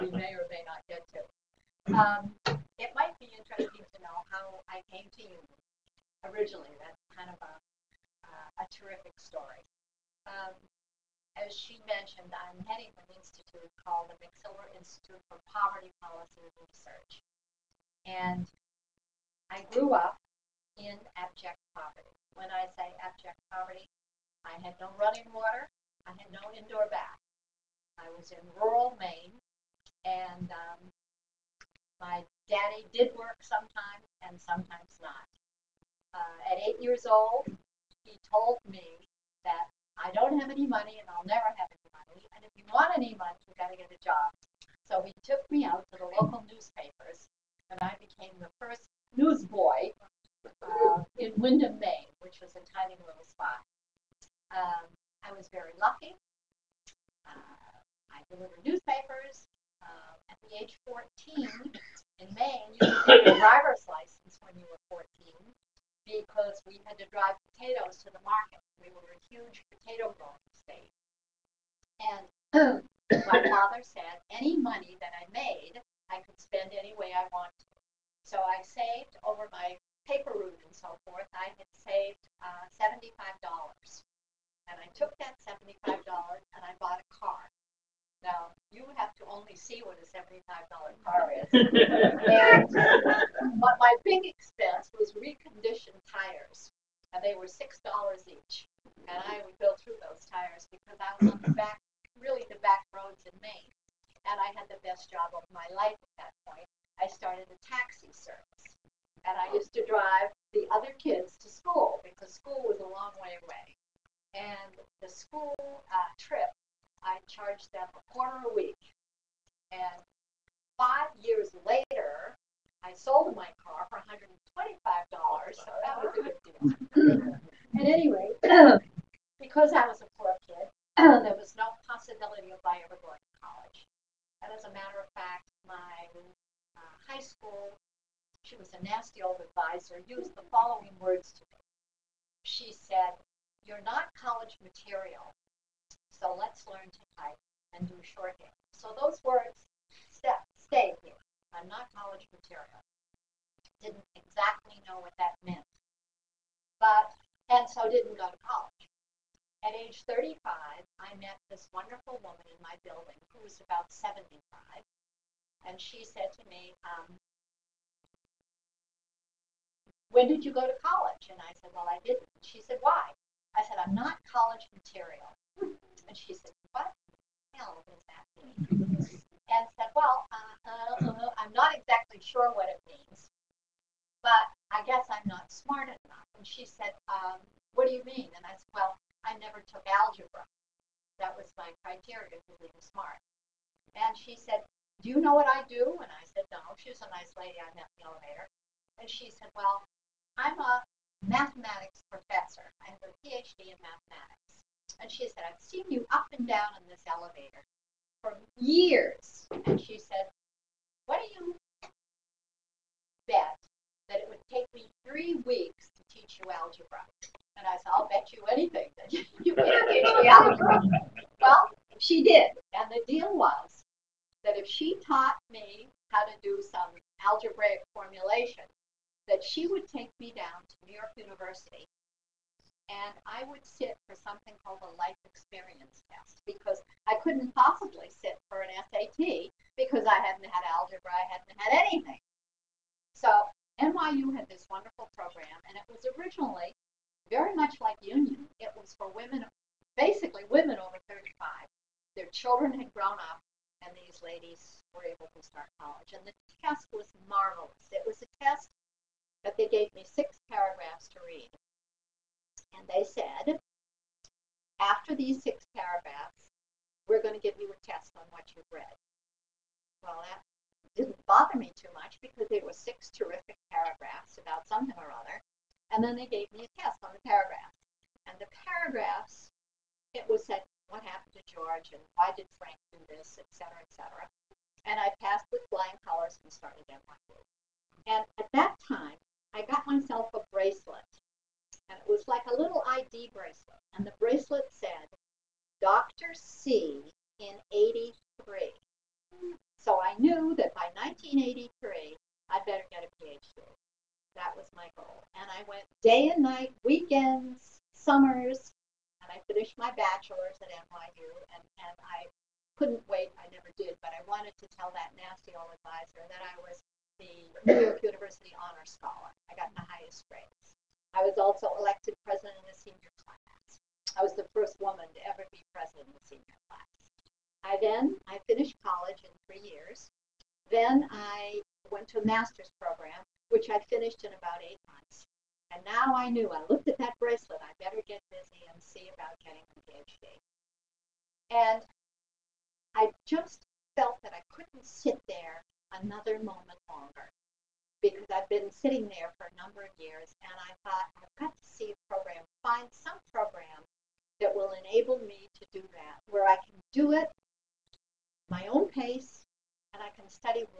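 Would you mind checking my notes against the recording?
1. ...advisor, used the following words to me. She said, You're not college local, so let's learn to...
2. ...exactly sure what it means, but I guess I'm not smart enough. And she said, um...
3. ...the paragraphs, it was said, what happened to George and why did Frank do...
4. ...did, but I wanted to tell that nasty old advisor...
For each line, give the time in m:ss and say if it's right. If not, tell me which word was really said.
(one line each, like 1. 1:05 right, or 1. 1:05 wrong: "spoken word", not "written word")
1. 2:19 wrong: "material", not "local"
2. 3:01 right
3. 4:38 right
4. 5:13 right.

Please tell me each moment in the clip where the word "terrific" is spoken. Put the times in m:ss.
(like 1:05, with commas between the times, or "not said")
0:08, 4:33.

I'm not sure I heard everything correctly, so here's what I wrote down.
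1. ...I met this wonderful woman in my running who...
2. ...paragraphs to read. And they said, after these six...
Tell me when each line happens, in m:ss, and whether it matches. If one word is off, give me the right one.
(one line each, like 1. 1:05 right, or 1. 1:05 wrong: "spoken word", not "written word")
1. 2:40 wrong: "building", not "running"
2. 4:20 right.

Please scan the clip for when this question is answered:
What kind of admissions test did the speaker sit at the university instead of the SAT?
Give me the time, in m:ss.
3:54.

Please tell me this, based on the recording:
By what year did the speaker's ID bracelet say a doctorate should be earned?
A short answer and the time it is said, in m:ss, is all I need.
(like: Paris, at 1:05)
1983, at 4:57.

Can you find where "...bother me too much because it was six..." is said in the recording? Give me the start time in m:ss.
4:31.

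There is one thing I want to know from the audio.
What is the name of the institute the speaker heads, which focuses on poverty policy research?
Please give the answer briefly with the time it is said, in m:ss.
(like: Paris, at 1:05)
McSilver Institute, at 0:14.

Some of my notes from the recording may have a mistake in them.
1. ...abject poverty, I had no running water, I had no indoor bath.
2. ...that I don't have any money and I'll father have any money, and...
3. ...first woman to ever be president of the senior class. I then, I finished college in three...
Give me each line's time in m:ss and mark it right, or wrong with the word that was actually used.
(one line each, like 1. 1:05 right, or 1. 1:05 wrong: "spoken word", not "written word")
1. 0:23 right
2. 0:39 wrong: "never", not "father"
3. 5:24 right.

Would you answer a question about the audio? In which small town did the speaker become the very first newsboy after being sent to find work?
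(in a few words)
Windham, Maine.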